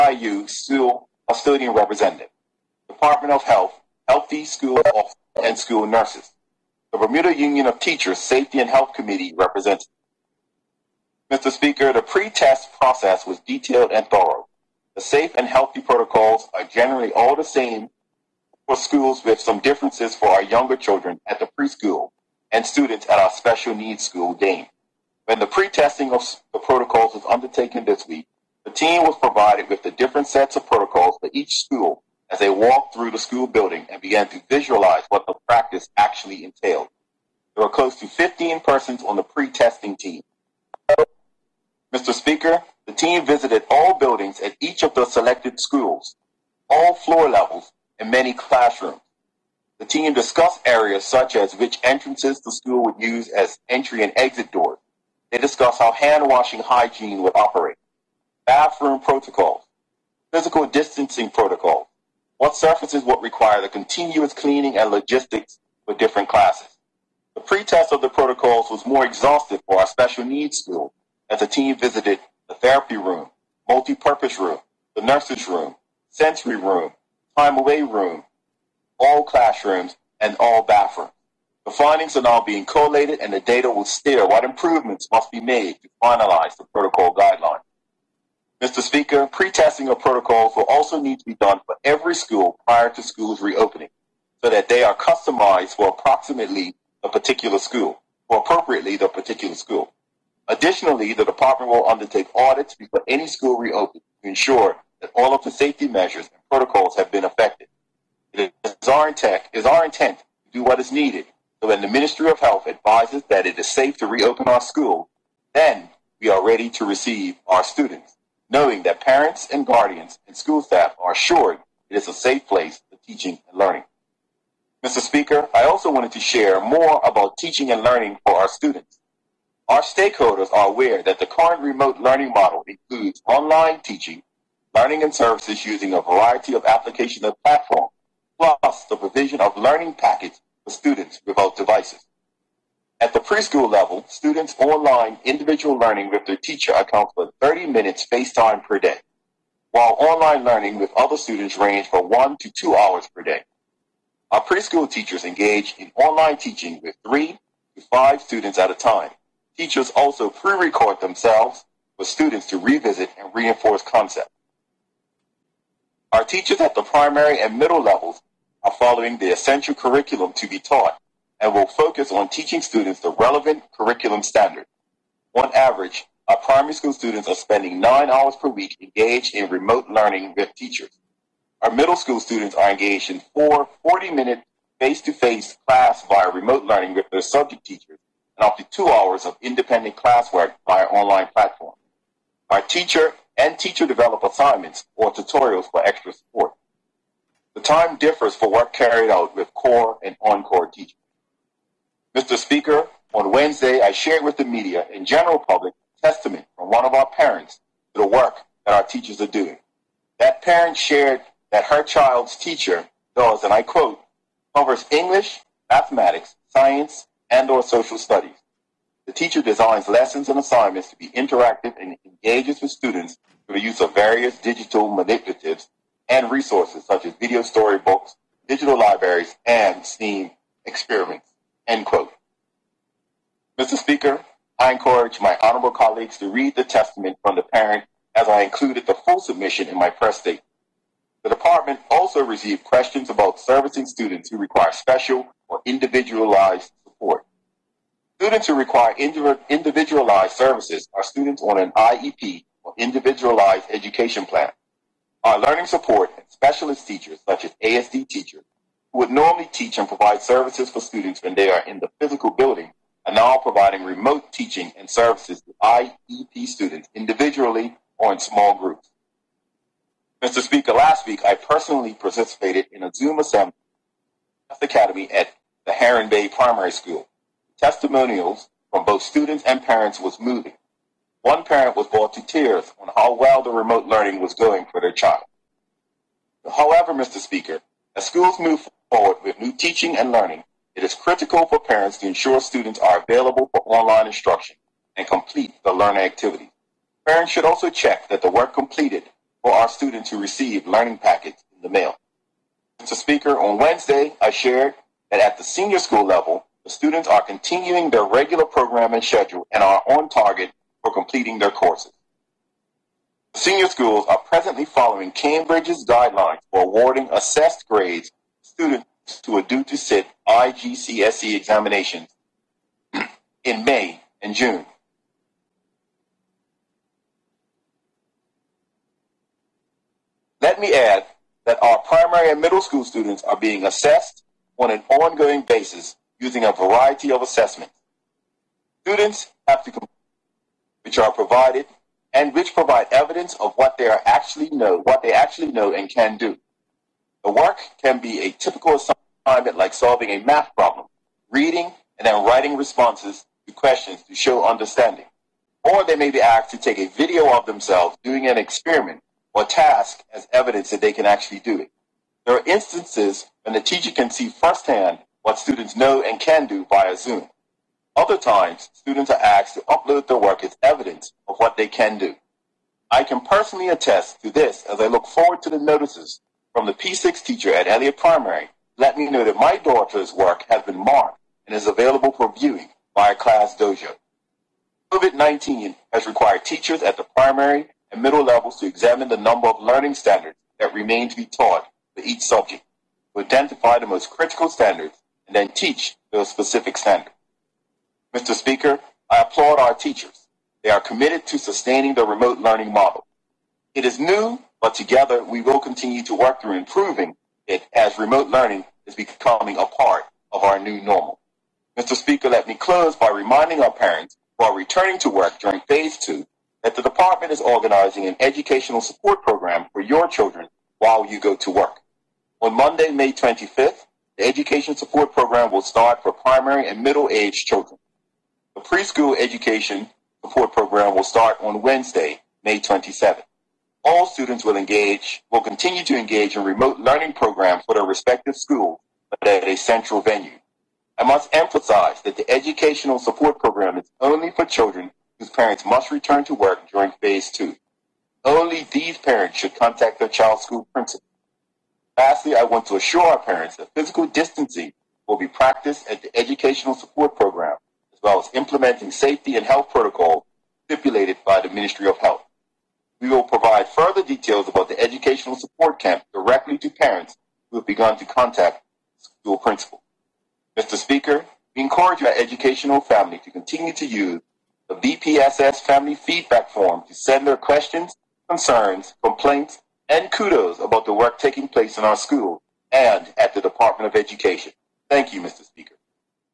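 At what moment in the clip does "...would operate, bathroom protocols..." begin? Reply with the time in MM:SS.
00:57.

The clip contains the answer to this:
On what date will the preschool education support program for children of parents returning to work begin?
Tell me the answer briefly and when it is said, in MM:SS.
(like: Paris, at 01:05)
May 27, at 07:11.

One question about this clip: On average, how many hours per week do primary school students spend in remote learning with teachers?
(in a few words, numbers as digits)
9 hours.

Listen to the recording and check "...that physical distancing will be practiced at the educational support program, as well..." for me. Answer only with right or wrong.
right.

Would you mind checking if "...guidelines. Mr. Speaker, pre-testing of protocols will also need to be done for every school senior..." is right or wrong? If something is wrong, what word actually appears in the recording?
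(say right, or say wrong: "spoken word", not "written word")
wrong: "prior", not "senior".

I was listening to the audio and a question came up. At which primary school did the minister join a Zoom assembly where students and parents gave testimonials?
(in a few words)
Heron Bay Primary School.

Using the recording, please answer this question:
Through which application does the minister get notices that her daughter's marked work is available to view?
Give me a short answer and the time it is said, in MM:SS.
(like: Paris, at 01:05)
Class Dojo, at 06:23.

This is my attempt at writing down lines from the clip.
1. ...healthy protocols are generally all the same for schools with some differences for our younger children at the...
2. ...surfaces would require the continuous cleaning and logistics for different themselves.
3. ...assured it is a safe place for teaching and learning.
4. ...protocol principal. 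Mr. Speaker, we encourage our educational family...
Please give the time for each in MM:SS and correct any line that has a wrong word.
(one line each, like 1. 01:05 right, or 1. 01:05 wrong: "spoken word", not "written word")
1. 00:15 right
2. 01:02 wrong: "classes", not "themselves"
3. 02:01 right
4. 07:48 wrong: "school", not "protocol".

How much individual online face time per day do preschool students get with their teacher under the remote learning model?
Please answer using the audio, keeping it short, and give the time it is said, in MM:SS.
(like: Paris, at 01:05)
30 minutes, at 02:27.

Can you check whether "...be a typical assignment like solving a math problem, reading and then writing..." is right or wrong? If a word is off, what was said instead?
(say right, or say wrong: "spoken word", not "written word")
right.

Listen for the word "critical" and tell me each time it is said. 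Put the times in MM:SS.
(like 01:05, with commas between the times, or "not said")
04:50, 06:34.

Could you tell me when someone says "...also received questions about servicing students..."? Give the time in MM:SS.
04:01.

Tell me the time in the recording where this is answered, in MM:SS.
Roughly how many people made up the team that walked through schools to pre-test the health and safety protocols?
00:37.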